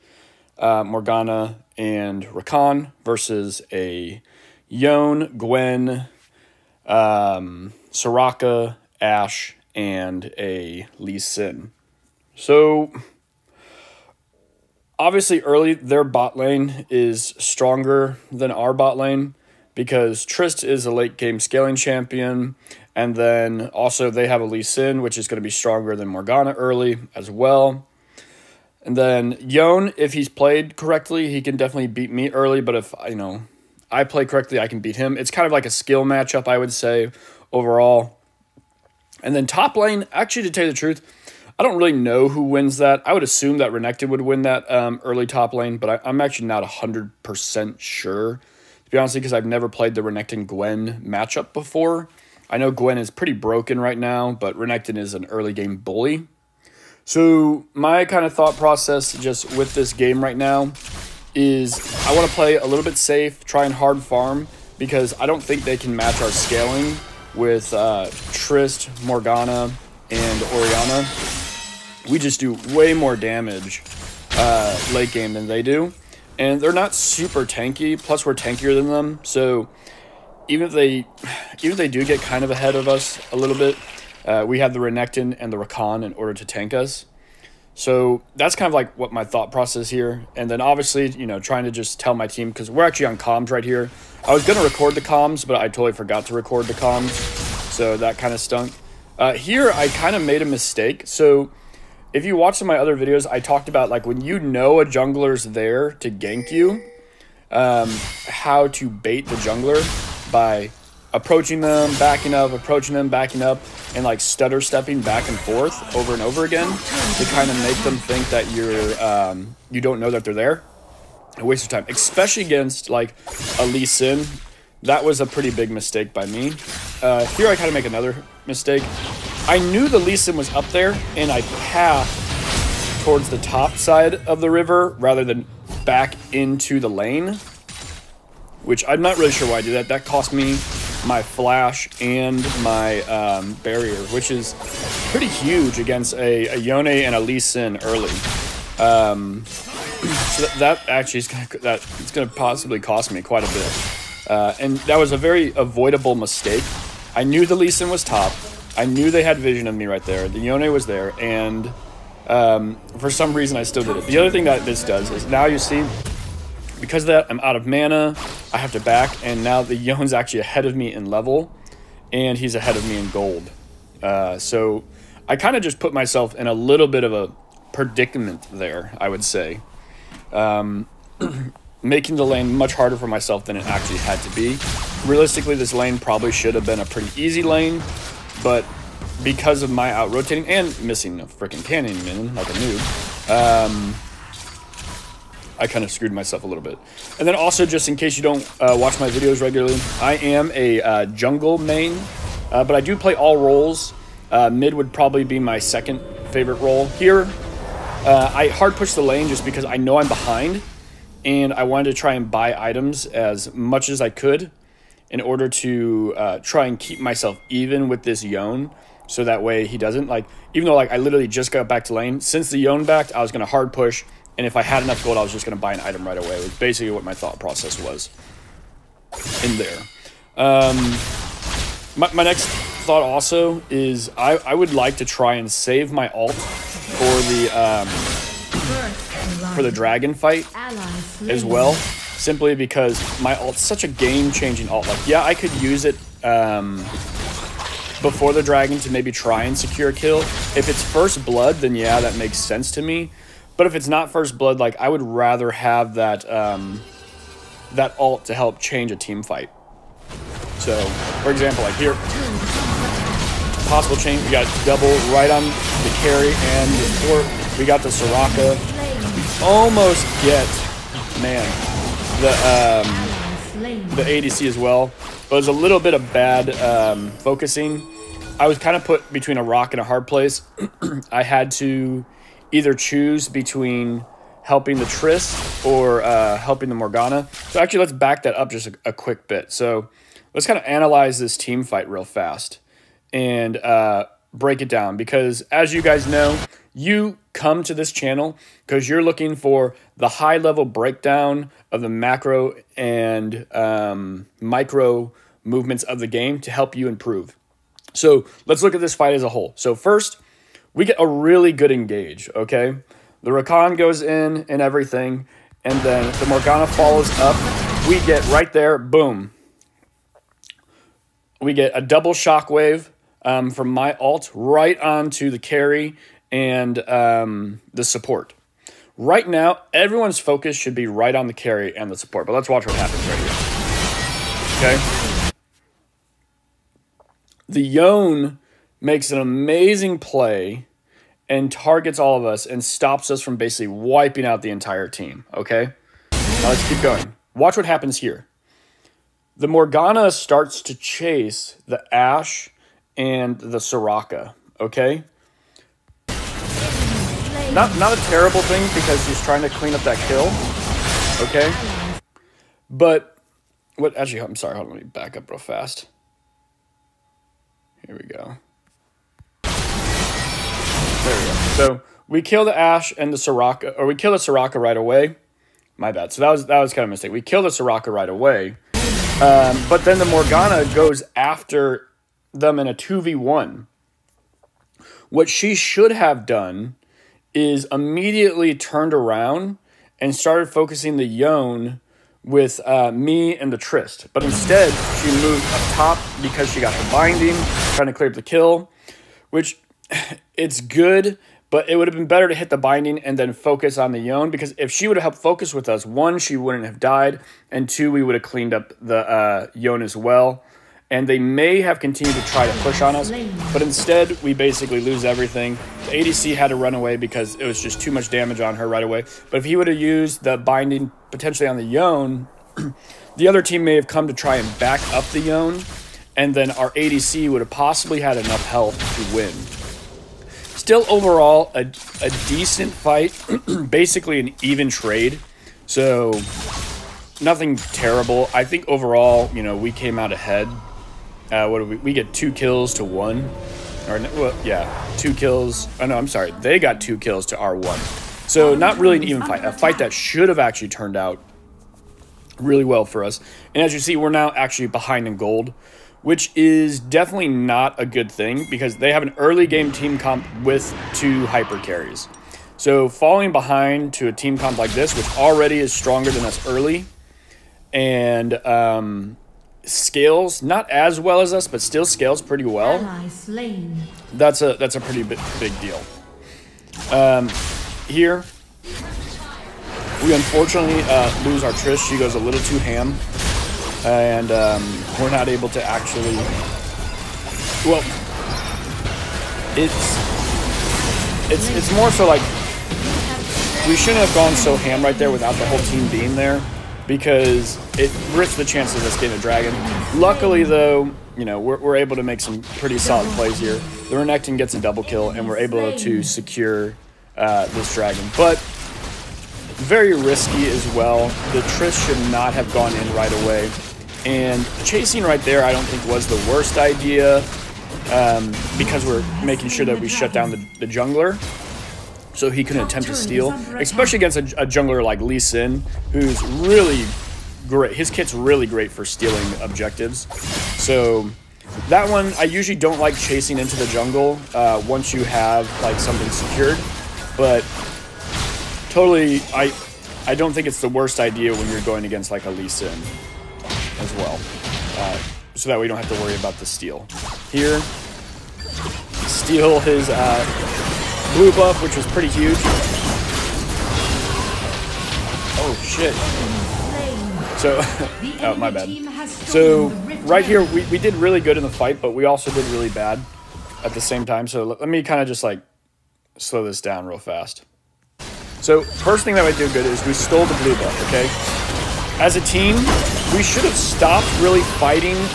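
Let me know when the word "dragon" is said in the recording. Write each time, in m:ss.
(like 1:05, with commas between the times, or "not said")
3:59, 4:08, 8:19, 8:27.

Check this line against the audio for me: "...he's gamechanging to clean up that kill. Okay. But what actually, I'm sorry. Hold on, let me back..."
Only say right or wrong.
wrong.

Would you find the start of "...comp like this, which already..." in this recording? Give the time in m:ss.
7:44.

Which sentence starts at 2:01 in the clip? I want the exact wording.
A waste of time, especially against like a Lee Sin.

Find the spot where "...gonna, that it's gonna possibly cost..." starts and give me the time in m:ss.
2:31.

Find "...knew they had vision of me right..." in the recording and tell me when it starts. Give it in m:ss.
2:38.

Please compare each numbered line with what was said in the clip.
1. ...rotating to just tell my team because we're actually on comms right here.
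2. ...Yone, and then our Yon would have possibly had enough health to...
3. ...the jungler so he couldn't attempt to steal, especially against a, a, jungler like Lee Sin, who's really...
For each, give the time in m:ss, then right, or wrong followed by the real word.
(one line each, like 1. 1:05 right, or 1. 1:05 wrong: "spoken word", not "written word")
1. 1:31 wrong: "trying", not "rotating"
2. 7:05 wrong: "ADC", not "Yon"
3. 8:40 right.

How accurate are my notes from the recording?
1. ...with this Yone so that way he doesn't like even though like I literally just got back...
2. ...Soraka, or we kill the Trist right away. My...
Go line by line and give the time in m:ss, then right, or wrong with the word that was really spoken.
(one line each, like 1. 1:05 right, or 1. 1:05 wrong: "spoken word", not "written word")
1. 3:37 right
2. 6:13 wrong: "Soraka", not "Trist".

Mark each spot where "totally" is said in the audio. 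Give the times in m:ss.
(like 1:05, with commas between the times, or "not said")
1:35, 8:58.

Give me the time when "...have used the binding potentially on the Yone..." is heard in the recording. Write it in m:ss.
6:59.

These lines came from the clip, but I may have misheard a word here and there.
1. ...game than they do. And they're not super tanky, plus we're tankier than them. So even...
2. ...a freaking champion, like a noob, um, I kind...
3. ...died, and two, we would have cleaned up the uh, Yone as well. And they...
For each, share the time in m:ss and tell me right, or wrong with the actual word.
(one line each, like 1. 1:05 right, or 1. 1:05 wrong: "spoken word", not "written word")
1. 1:15 right
2. 3:11 wrong: "cannon", not "champion"
3. 6:46 right.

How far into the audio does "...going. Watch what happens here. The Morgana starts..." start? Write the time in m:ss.
5:46.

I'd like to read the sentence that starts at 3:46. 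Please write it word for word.
It was basically what my thought process was in there.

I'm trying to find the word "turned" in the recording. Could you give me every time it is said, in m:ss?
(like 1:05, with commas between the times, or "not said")
6:28, 7:30.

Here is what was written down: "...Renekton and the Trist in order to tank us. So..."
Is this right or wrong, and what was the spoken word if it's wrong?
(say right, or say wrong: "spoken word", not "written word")
wrong: "Rakan", not "Trist".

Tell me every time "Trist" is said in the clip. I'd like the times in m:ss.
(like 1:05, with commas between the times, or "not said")
0:20, 1:08, 4:44, 6:33, 8:01, 8:31.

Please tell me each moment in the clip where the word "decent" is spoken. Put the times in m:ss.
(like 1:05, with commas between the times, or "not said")
7:12.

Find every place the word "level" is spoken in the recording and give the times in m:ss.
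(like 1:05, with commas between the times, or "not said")
2:51, 5:00.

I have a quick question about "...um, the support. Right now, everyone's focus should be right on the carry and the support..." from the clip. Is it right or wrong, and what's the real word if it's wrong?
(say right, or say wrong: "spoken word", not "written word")
right.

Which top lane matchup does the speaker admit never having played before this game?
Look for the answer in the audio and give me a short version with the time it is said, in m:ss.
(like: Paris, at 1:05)
Renekton Gwen, at 0:50.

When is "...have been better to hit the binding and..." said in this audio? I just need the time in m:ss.
6:41.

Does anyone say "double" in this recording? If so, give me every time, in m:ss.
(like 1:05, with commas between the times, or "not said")
4:24, 5:21, 8:24.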